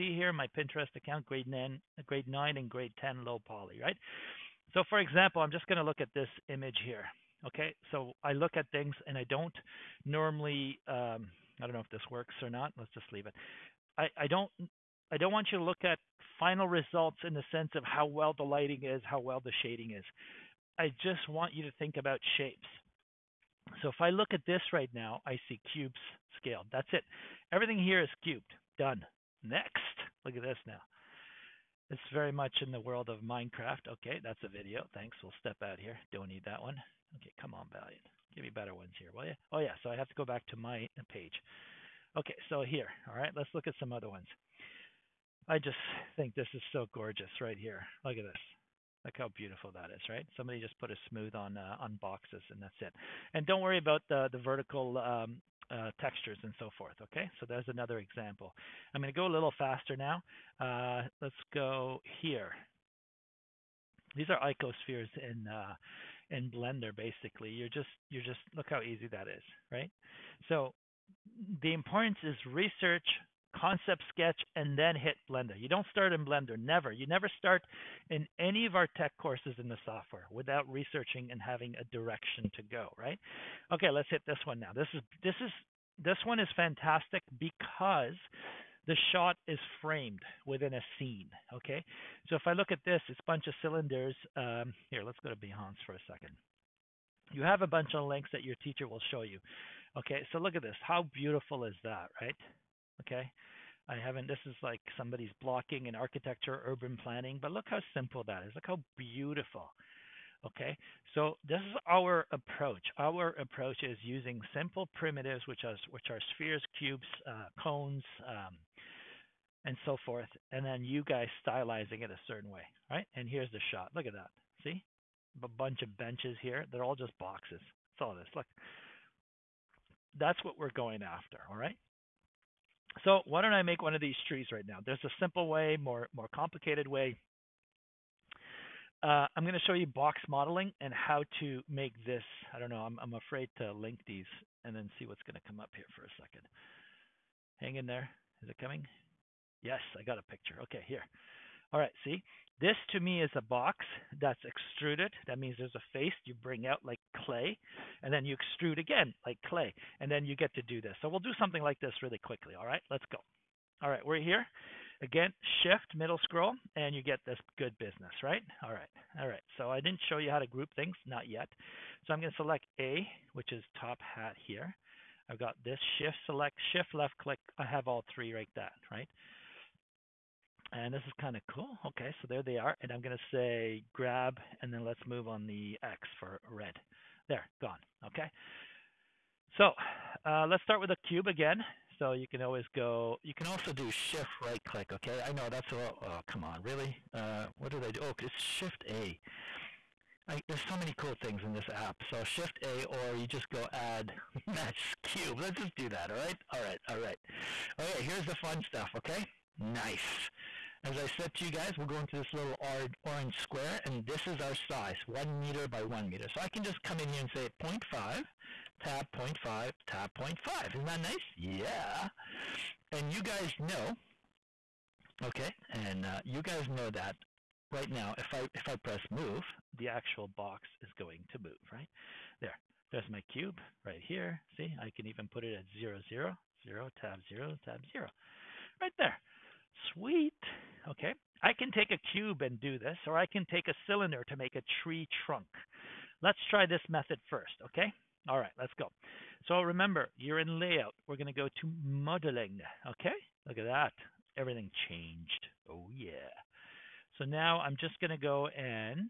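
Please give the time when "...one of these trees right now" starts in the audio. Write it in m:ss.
2:13.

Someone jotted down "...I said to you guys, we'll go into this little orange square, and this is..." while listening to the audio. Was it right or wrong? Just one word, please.
right.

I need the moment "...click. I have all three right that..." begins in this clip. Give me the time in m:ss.
2:57.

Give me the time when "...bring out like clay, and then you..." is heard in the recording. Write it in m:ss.
2:36.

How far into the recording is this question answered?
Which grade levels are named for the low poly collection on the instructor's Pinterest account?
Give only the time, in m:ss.
0:02.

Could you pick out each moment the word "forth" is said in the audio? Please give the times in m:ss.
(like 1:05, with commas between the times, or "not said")
0:56, 2:00.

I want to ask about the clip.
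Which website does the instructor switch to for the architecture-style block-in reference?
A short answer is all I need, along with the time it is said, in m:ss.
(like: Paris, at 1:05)
Behance, at 1:35.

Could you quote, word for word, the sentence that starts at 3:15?
I know that's a little, oh, come on, really?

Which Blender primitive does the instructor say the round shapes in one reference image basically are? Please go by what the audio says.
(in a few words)
Icospheres.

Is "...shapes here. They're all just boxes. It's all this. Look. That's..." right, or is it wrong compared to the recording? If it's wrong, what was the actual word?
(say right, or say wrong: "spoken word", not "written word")
wrong: "benches", not "shapes".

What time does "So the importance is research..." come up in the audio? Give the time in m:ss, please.
1:10.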